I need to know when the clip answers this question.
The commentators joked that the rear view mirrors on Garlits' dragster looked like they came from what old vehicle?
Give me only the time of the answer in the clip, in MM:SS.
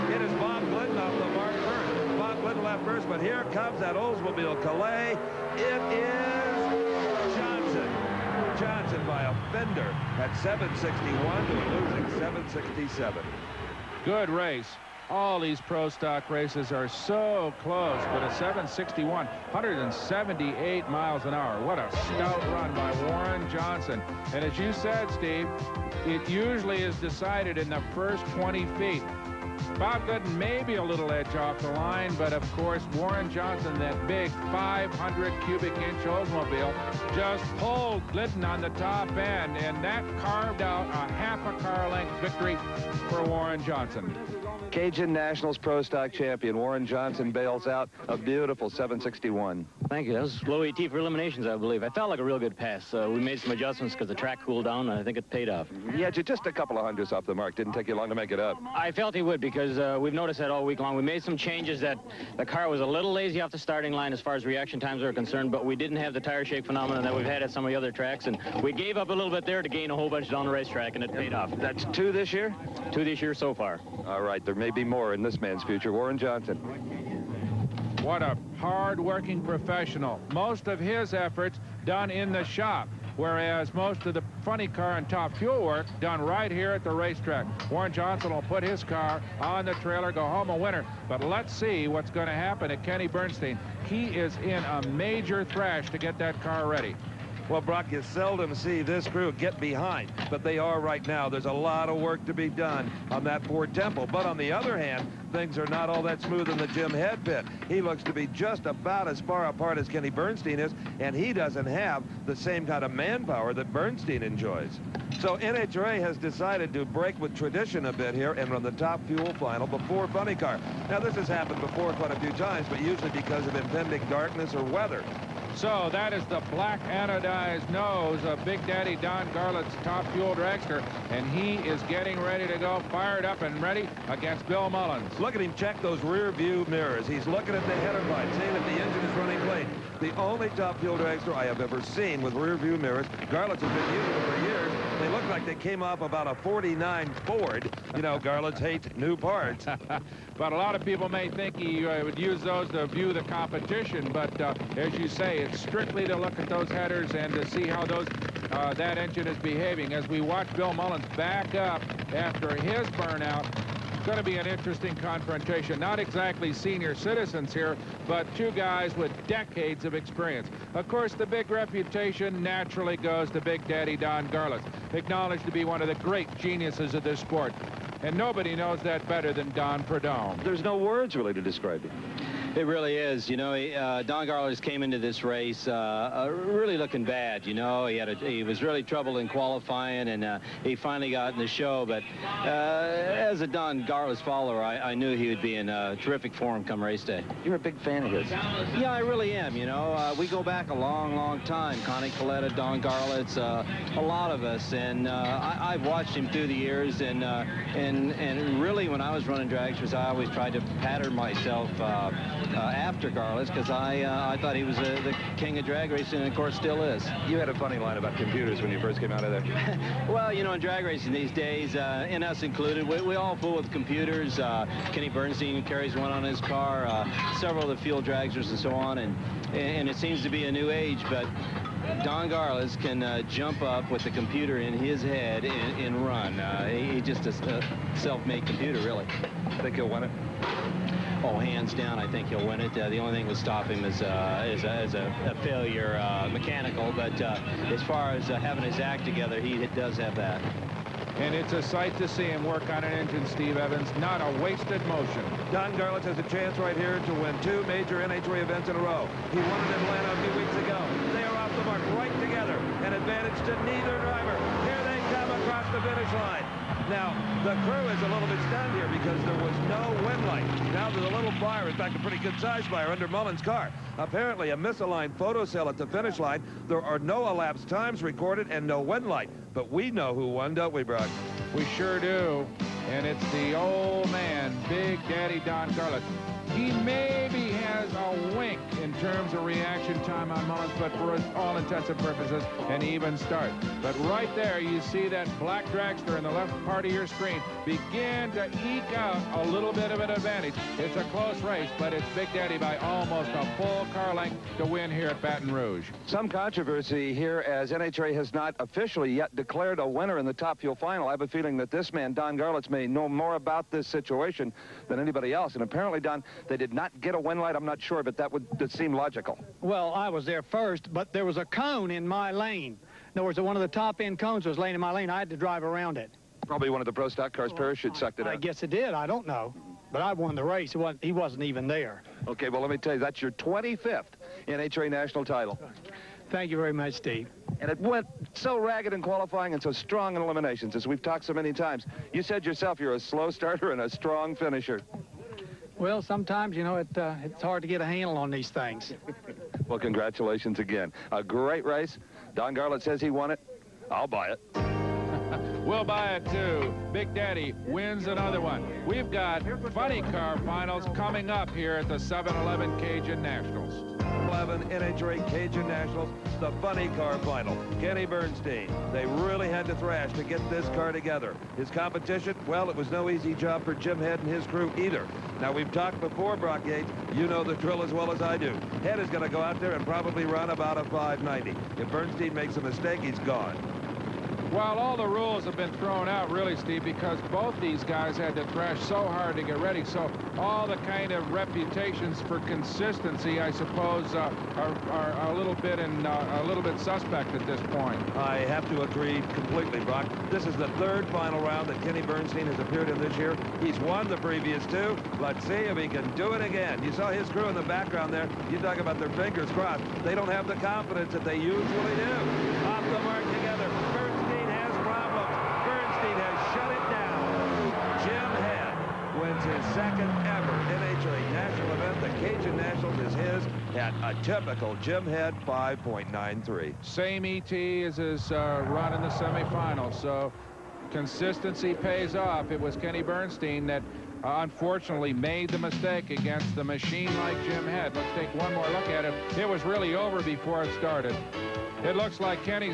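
02:26.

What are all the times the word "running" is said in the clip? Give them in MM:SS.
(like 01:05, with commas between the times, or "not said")
02:19, 03:29.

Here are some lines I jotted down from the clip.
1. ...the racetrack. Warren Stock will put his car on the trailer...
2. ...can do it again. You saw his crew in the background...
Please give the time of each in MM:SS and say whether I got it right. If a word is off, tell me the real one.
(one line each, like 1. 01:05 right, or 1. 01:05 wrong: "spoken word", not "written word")
1. 01:26 wrong: "Johnson", not "Stock"
2. 06:45 right.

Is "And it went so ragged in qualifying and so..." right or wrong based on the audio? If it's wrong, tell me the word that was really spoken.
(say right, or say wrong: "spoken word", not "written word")
right.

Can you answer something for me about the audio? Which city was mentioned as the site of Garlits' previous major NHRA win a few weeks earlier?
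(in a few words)
Atlanta.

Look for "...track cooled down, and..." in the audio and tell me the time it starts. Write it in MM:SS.
00:54.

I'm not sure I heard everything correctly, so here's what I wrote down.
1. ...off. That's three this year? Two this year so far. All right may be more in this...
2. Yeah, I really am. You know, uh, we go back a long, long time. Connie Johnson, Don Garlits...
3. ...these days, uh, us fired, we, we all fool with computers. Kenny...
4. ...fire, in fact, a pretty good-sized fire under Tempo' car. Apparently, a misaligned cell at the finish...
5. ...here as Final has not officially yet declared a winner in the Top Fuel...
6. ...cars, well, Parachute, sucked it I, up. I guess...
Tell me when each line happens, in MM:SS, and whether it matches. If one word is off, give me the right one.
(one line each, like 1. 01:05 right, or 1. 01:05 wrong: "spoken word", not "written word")
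1. 01:11 wrong: "two", not "three"
2. 03:18 wrong: "Kalitta", not "Johnson"
3. 03:41 wrong: "included", not "fired"
4. 04:31 wrong: "Mullins", not "Tempo"
5. 05:07 wrong: "NHRA", not "Final"
6. 05:27 right.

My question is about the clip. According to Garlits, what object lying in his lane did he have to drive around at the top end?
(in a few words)
a cone.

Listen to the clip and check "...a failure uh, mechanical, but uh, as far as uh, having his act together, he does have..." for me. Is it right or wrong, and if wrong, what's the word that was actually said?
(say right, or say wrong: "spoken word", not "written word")
right.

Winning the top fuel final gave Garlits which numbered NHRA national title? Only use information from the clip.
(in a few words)
25th.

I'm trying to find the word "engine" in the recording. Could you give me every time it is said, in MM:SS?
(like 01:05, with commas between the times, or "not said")
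02:18, 02:38, 04:12.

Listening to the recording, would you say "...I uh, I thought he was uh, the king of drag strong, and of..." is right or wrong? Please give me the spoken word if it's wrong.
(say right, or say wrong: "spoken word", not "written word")
wrong: "racing", not "strong".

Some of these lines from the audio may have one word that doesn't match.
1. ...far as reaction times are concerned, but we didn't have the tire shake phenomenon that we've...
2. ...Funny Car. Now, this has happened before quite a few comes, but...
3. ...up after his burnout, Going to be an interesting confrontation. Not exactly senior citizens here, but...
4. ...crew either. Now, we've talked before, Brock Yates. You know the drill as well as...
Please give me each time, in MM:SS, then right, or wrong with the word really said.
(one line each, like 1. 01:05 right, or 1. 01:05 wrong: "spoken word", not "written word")
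1. 01:04 right
2. 02:00 wrong: "times", not "comes"
3. 02:41 right
4. 06:14 right.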